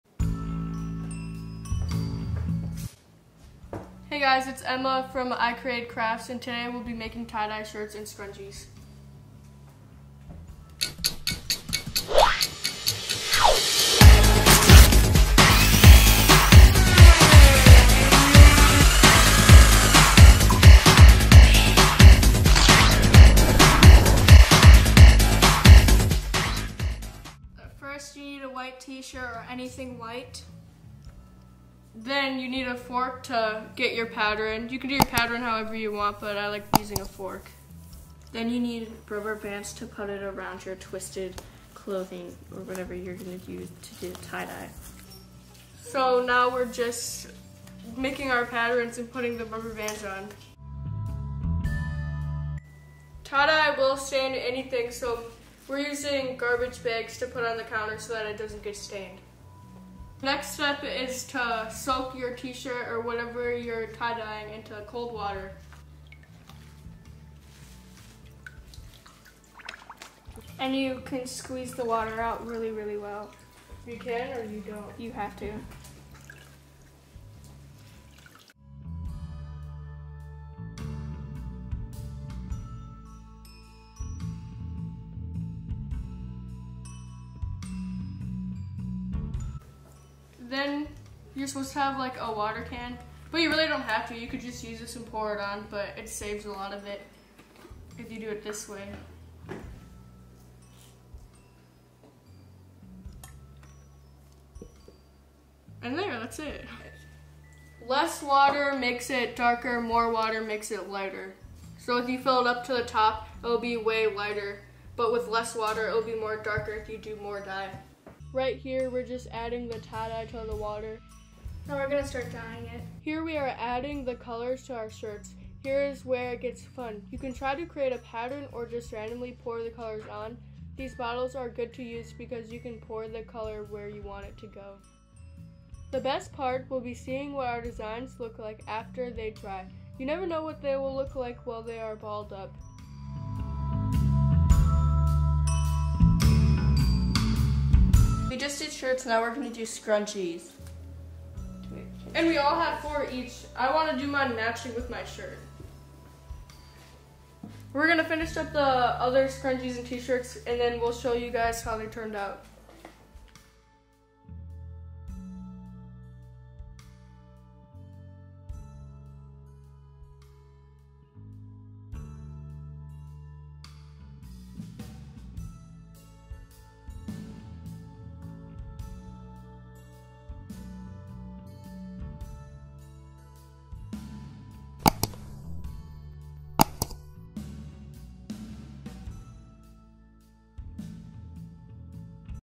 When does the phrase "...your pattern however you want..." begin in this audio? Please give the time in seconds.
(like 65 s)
34 s.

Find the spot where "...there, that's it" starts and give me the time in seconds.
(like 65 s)
105 s.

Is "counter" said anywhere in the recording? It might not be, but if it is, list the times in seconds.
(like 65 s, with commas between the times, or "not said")
57 s.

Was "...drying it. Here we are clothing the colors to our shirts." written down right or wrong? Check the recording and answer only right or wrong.
wrong.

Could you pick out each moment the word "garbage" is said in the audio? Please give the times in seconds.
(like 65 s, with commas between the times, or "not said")
56 s.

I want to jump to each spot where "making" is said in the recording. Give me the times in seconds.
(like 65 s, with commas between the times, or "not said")
6 s, 47 s.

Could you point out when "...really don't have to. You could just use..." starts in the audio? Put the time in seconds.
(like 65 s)
93 s.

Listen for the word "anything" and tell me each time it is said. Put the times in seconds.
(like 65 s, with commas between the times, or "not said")
29 s, 54 s.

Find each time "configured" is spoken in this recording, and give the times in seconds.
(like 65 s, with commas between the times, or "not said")
not said.